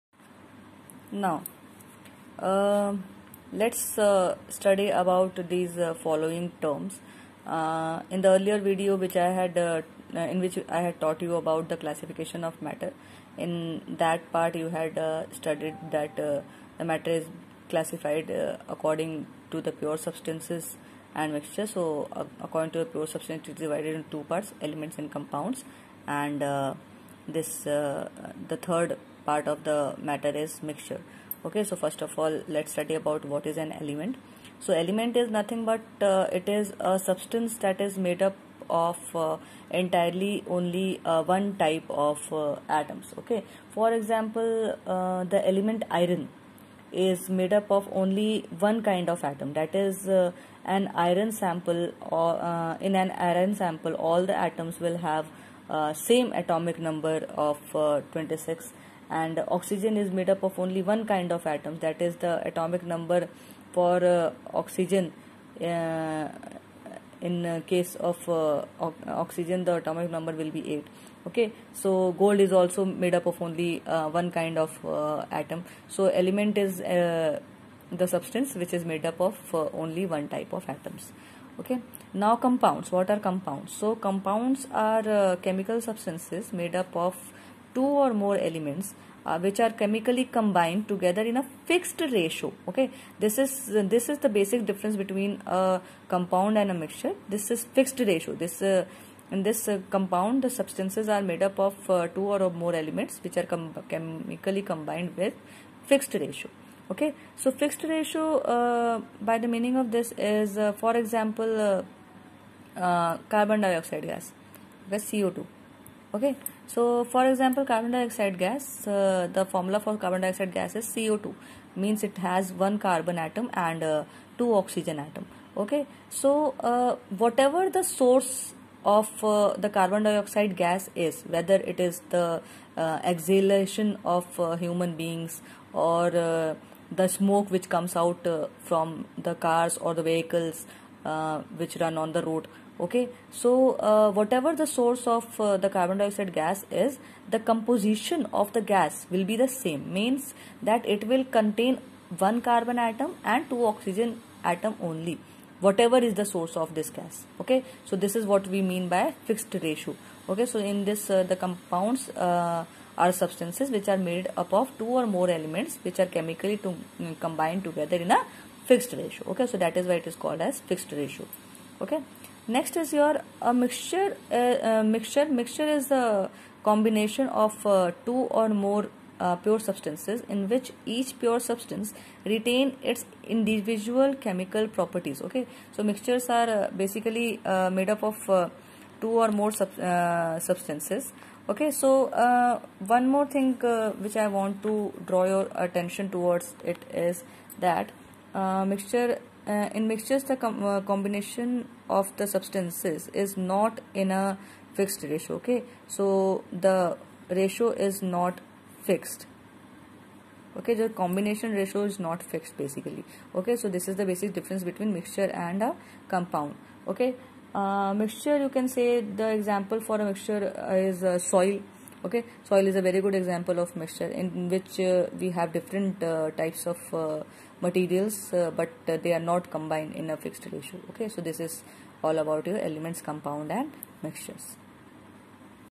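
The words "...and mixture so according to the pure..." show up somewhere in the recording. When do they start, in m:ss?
0:21.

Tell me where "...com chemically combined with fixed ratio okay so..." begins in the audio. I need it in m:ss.
1:43.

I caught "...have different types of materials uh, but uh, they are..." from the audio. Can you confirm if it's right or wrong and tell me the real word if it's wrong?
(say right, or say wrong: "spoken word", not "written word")
right.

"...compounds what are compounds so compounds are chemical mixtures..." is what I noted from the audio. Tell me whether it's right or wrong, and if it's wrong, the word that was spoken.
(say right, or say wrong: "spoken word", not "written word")
wrong: "substances", not "mixtures".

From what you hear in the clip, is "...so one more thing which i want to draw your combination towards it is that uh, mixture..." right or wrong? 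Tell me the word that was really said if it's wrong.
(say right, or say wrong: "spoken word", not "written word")
wrong: "attention", not "combination".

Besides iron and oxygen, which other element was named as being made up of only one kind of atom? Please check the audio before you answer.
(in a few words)
Gold.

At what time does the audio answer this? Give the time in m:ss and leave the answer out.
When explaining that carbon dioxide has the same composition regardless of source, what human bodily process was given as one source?
2:13.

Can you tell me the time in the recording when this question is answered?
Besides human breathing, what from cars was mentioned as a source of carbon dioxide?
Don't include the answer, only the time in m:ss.
2:17.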